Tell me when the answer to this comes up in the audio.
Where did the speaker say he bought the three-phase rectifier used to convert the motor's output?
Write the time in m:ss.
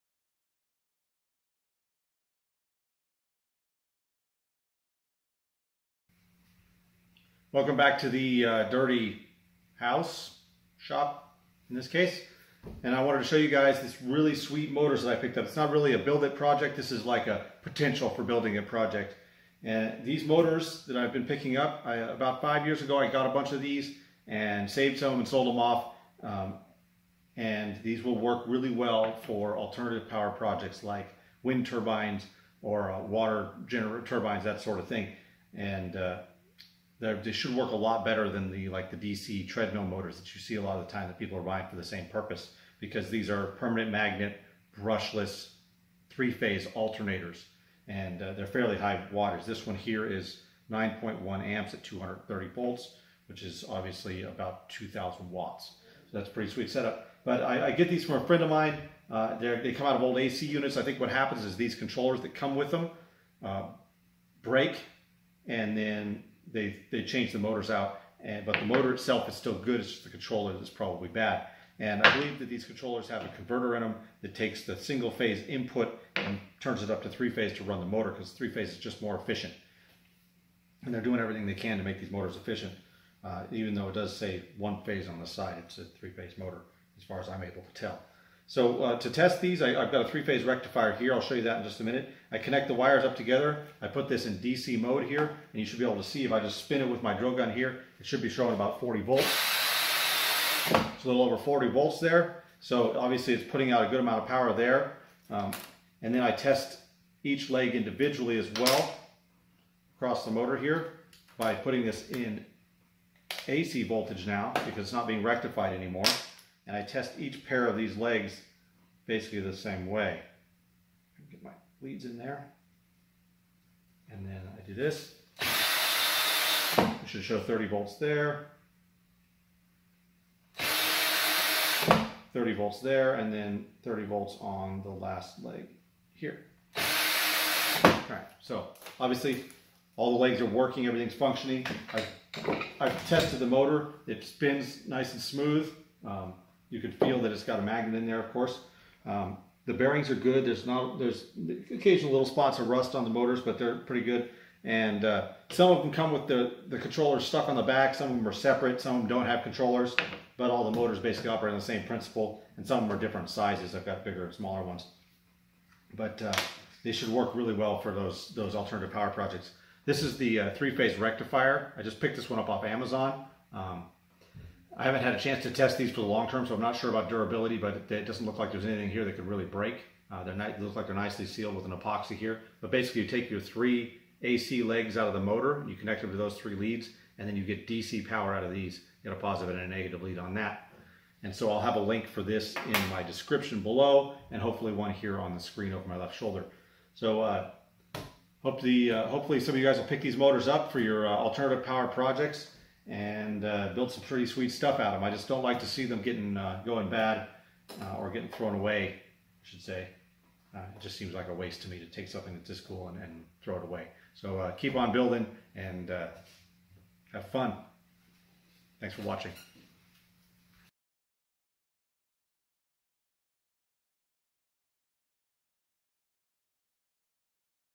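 2:52.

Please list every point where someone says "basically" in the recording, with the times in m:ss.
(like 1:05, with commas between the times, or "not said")
1:59, 2:40, 3:02.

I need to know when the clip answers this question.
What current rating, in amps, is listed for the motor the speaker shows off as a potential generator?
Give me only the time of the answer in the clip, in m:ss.
0:50.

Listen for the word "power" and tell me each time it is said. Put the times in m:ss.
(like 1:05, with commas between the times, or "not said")
0:30, 1:44, 2:48, 3:08, 3:21.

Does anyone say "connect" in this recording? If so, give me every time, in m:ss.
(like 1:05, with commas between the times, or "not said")
1:32, 3:05.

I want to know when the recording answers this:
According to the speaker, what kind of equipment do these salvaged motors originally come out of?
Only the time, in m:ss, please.
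1:00.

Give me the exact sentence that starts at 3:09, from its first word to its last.
You get a positive and a negative lead on that.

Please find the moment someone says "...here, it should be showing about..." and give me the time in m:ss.
1:37.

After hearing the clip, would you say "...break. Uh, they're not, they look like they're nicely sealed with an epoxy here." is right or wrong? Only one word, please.
right.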